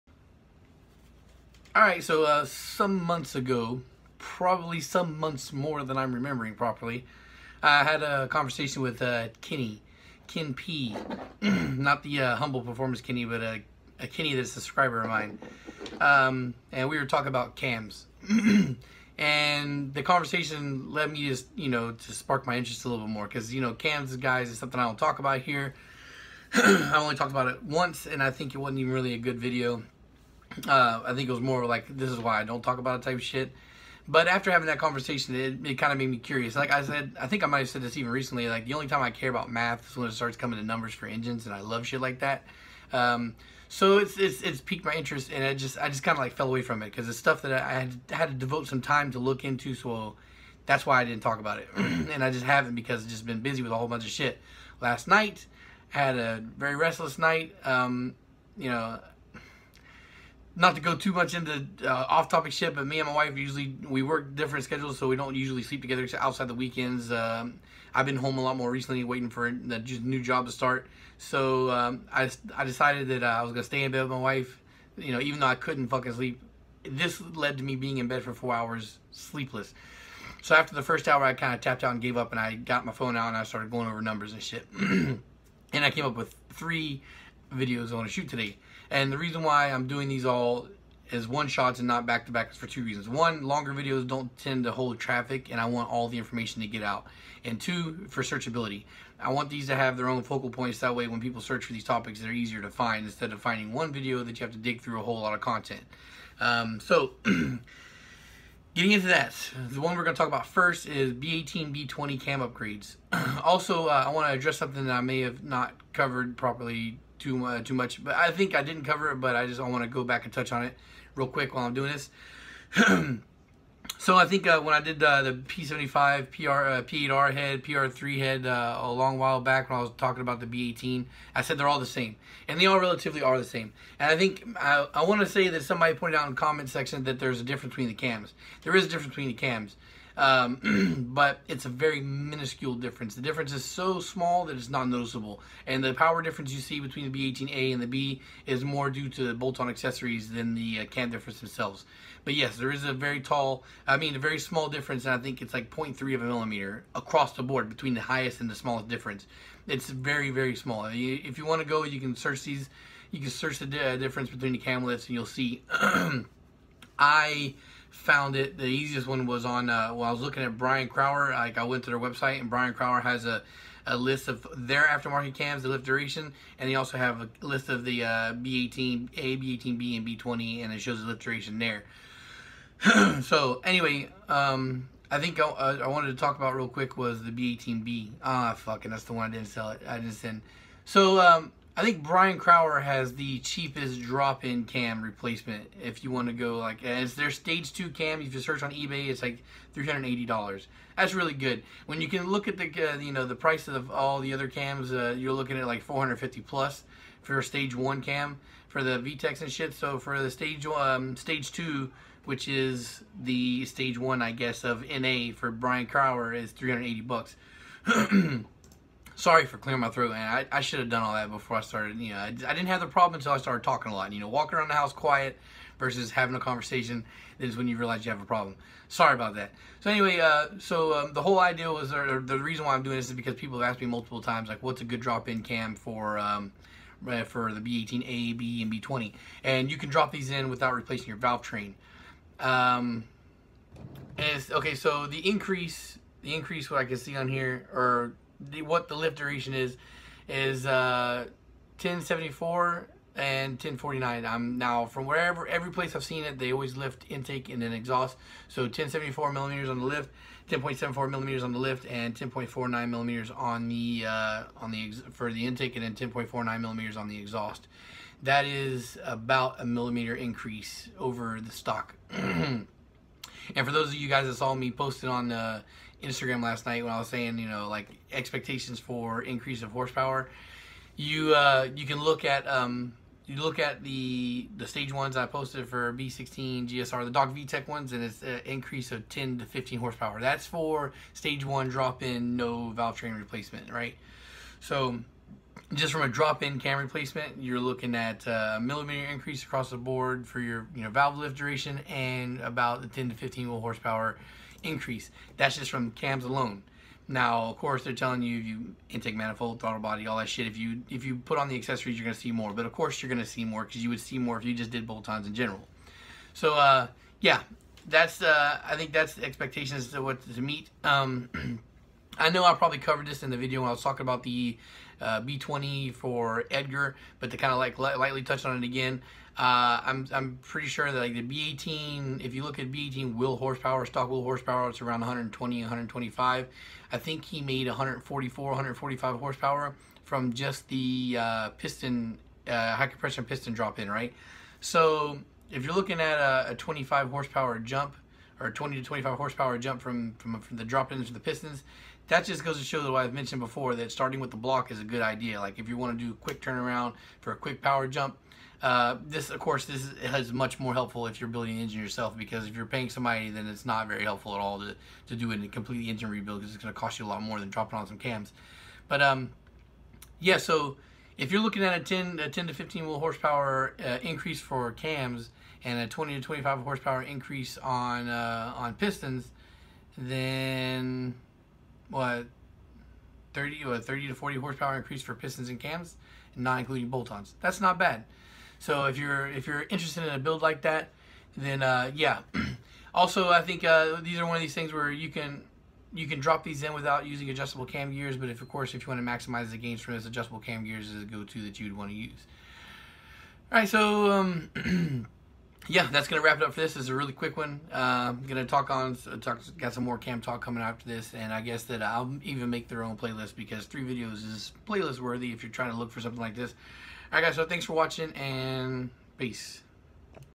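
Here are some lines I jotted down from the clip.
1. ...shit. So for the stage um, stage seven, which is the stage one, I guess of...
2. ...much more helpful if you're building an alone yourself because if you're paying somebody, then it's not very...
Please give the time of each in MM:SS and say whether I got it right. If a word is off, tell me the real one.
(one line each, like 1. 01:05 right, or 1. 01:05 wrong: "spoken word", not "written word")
1. 03:29 wrong: "two", not "seven"
2. 06:00 wrong: "engine", not "alone".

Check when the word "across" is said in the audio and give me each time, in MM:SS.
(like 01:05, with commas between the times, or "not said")
02:36, 04:59.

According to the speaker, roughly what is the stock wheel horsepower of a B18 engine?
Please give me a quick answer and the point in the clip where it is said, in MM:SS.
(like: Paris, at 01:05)
120 to 125, at 05:35.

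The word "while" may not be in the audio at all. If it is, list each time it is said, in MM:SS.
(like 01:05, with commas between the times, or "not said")
02:01, 02:09.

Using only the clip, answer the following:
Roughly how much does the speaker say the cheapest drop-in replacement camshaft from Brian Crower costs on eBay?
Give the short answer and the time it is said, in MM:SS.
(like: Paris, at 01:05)
$380, at 03:19.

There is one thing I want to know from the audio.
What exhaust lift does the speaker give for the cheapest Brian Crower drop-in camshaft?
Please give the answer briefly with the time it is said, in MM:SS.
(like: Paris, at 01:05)
10.49 mm, at 04:26.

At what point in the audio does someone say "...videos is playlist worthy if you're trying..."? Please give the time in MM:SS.
06:53.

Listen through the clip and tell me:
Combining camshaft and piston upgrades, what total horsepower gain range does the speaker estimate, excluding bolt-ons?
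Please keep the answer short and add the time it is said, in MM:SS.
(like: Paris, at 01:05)
30 to 40, at 06:23.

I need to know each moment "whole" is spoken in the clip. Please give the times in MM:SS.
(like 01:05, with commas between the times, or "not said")
00:53, 01:45, 03:51.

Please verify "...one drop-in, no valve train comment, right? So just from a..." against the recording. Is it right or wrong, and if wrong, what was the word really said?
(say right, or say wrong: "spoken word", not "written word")
wrong: "replacement", not "comment".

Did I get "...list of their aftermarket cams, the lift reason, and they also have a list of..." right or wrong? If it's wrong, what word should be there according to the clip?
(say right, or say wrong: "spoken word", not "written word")
wrong: "duration", not "reason".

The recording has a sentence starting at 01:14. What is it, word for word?
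You know, even though I couldn't fucking sleep, this led to me being in bed for four hours sleepless.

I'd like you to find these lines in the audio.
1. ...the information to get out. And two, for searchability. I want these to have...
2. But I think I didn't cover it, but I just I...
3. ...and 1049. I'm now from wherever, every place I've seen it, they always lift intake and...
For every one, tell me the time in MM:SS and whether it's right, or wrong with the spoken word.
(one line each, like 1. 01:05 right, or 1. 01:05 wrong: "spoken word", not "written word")
1. 01:36 right
2. 01:58 right
3. 04:13 right.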